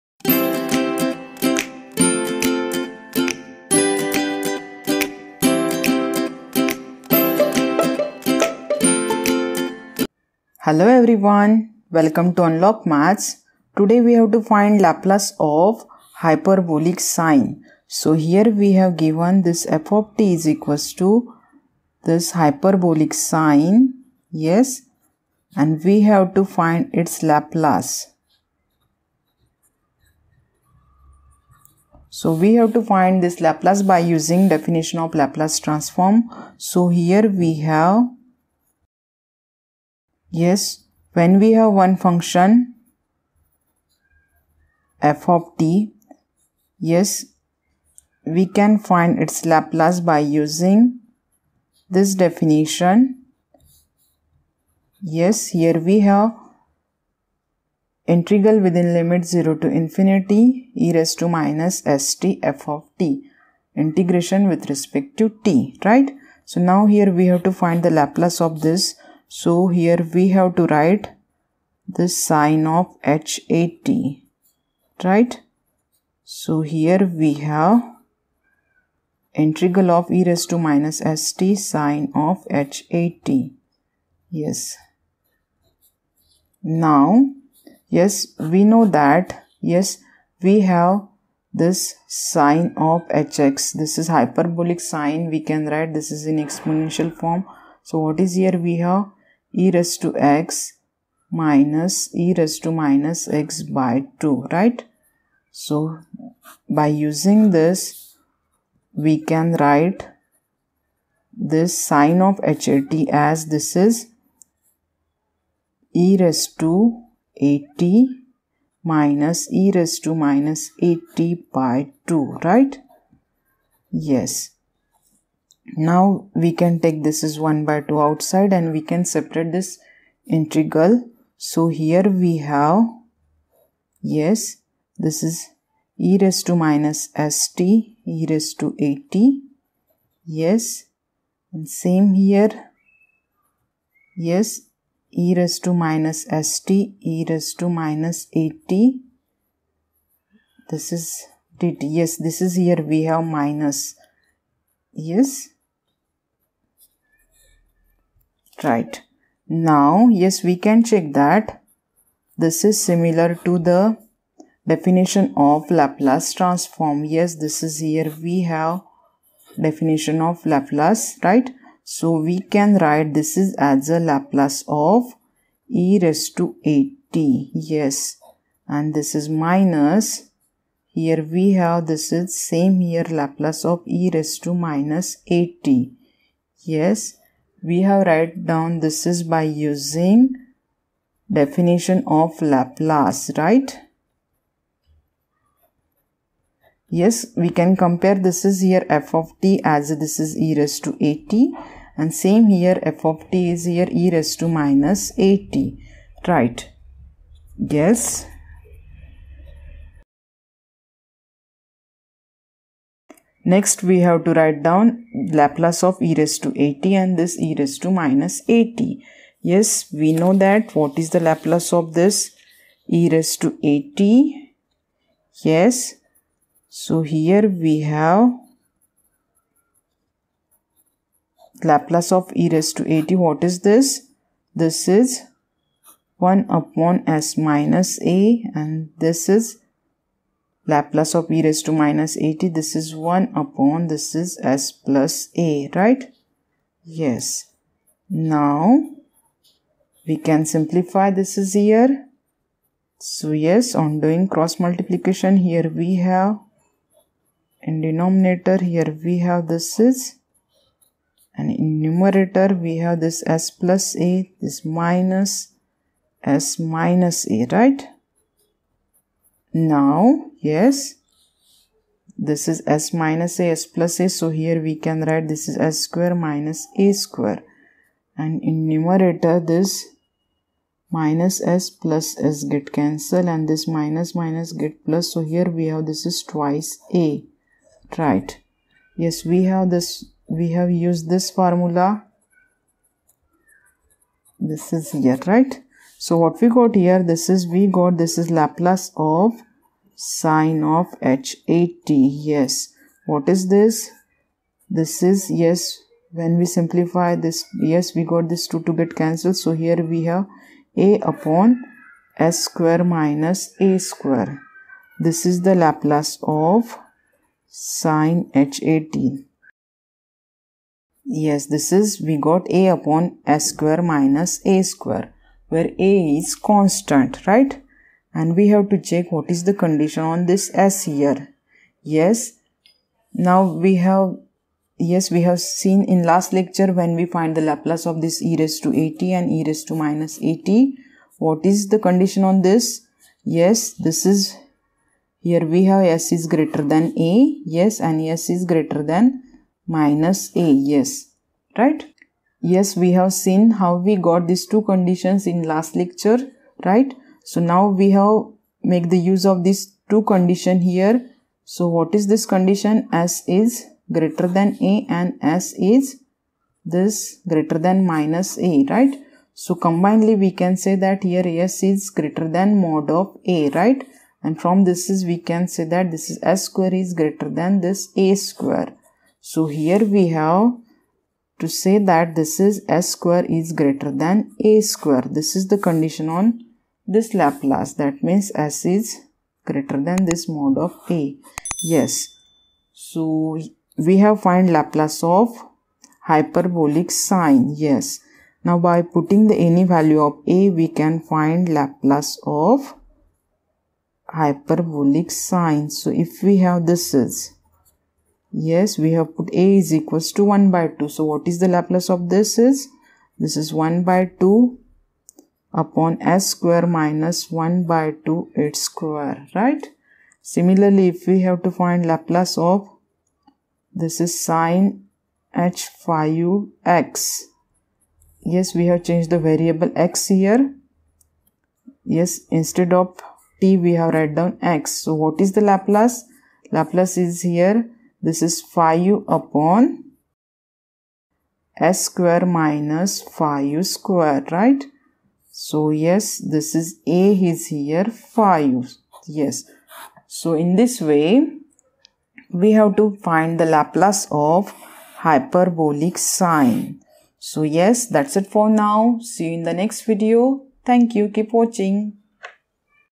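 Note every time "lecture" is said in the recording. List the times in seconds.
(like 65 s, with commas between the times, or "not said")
336 s, 355 s.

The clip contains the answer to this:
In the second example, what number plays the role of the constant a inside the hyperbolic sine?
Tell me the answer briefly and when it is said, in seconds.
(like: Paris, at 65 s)
5, at 446 s.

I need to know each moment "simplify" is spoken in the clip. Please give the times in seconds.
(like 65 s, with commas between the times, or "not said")
250 s, 306 s.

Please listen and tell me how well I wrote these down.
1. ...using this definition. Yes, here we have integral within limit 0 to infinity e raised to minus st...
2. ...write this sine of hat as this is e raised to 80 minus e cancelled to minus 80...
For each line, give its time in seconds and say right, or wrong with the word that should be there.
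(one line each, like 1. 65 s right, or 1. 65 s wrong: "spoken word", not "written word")
1. 50 s right
2. 109 s wrong: "raised", not "cancelled".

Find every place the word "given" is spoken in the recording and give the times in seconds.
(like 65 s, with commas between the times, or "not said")
18 s.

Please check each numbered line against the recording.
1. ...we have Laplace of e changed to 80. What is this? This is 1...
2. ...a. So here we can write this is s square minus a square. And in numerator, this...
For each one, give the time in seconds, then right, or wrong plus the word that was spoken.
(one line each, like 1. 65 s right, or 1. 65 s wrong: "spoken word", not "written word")
1. 227 s wrong: "raised", not "changed"
2. 273 s right.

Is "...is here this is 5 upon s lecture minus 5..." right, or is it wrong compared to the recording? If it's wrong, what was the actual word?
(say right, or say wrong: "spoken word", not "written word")
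wrong: "square", not "lecture".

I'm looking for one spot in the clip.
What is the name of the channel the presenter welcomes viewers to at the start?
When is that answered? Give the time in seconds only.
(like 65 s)
12 s.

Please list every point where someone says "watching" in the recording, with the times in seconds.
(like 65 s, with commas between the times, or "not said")
461 s.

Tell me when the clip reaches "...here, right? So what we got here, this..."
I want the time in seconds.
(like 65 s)
294 s.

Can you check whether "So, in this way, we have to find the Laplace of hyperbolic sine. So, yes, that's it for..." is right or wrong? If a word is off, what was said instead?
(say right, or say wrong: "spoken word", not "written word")
right.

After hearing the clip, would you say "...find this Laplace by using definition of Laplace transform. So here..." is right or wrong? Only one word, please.
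right.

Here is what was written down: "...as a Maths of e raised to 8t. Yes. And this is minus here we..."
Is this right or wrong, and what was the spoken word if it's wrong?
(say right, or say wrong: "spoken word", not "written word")
wrong: "Laplace", not "Maths".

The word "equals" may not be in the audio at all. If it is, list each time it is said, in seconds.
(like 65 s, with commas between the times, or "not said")
20 s, 409 s.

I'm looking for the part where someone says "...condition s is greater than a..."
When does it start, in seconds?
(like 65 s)
362 s.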